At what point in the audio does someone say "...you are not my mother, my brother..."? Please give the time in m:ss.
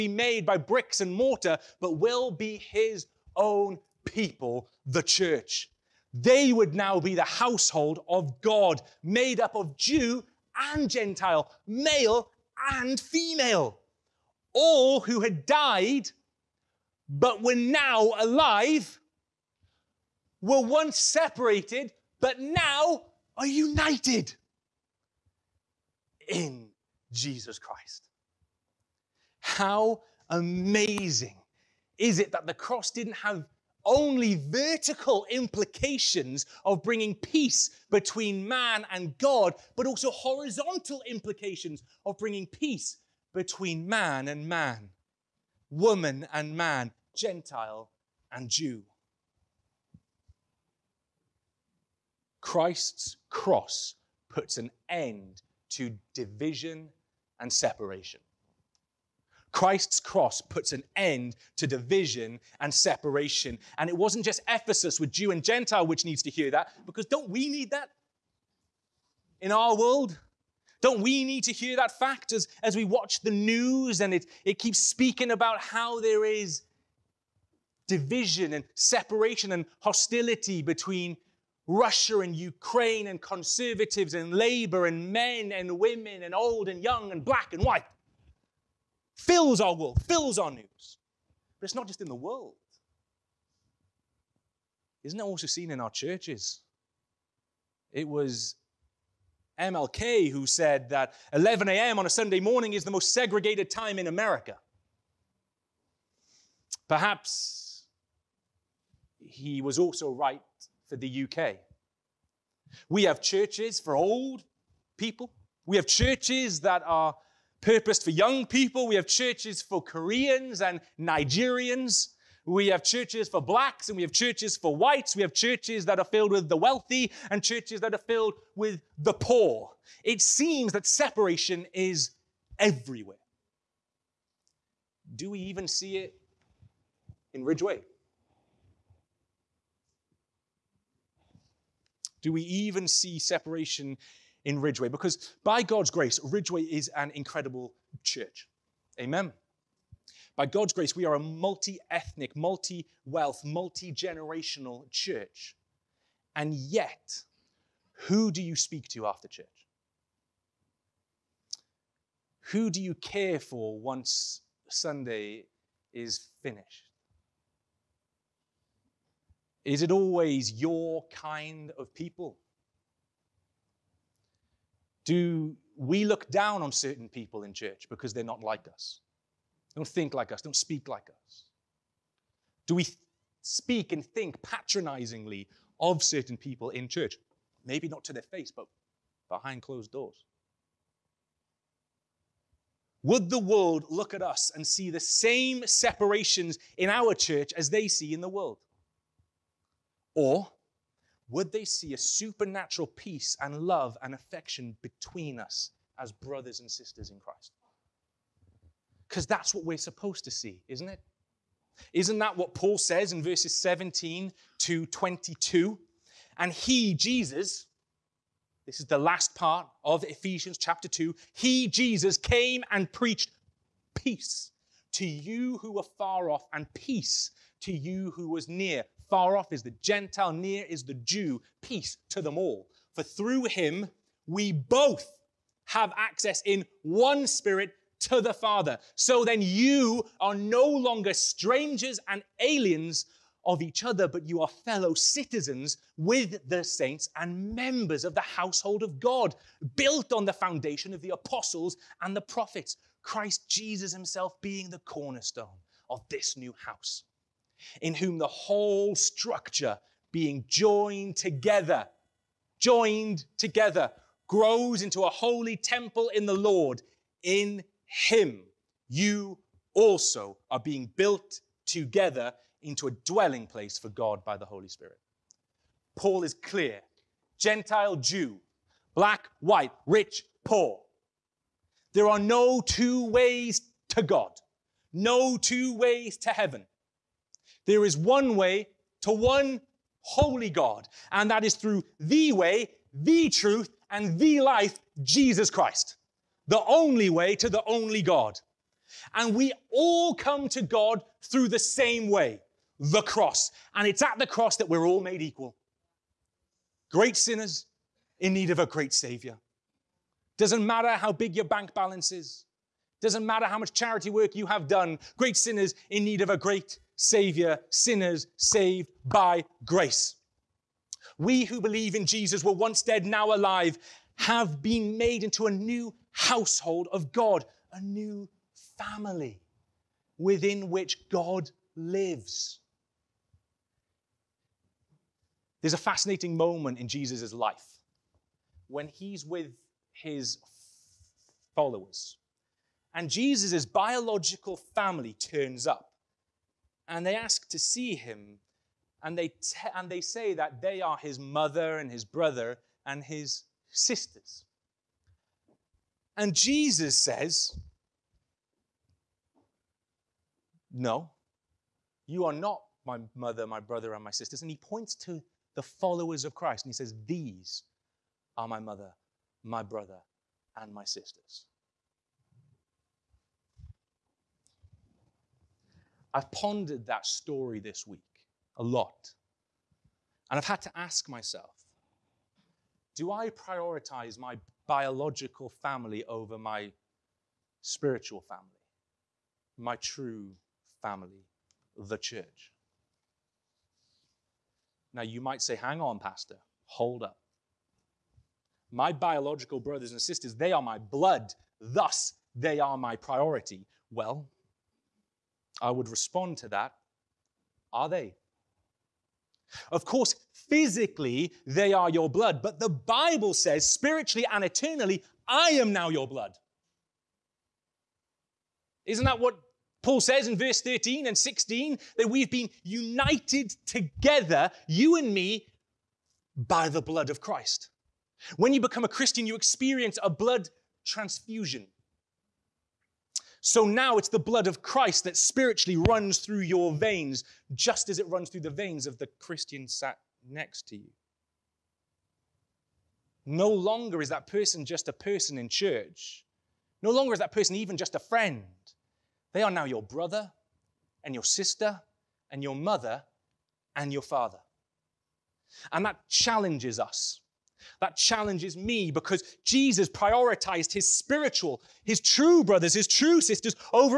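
6:02.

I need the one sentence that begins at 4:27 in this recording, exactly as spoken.
In him, you also are being built together into a dwelling place for God by the Holy Spirit.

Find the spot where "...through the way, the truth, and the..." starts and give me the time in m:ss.
4:51.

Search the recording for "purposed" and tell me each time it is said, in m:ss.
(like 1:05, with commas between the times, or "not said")
1:57.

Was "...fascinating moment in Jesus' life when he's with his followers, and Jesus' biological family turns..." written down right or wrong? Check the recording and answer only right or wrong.
right.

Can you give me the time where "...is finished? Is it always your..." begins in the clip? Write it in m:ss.
2:45.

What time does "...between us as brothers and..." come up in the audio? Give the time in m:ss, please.
3:24.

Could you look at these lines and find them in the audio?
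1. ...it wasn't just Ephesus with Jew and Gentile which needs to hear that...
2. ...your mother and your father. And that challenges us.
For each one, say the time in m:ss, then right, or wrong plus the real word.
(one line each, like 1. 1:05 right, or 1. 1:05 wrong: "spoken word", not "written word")
1. 1:03 right
2. 7:32 right.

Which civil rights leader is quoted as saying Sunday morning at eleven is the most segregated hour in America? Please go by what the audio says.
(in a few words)
MLK.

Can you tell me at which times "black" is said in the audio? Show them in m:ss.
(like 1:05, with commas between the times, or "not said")
1:27, 2:03, 4:38.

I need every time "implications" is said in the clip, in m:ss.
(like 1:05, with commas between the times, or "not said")
0:35, 0:41.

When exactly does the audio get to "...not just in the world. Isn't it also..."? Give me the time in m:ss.
1:31.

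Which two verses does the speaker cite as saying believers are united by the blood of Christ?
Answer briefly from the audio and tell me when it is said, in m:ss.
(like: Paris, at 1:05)
13 and 16, at 7:00.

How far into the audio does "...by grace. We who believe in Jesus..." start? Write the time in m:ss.
5:19.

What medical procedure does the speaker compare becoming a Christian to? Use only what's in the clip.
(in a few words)
blood transfusion.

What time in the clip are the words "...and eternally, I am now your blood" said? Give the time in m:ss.
6:54.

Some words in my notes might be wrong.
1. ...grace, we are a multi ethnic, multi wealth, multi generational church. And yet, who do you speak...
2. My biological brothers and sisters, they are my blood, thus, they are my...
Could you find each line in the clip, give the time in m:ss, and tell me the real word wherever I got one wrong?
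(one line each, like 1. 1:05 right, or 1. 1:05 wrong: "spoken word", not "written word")
1. 2:30 right
2. 6:38 right.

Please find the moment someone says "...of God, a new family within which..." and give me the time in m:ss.
5:26.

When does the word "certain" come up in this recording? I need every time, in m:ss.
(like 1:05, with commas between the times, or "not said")
2:56, 3:06.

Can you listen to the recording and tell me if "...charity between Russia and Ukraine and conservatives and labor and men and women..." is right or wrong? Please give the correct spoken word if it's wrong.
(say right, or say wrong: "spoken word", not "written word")
wrong: "hostility", not "charity".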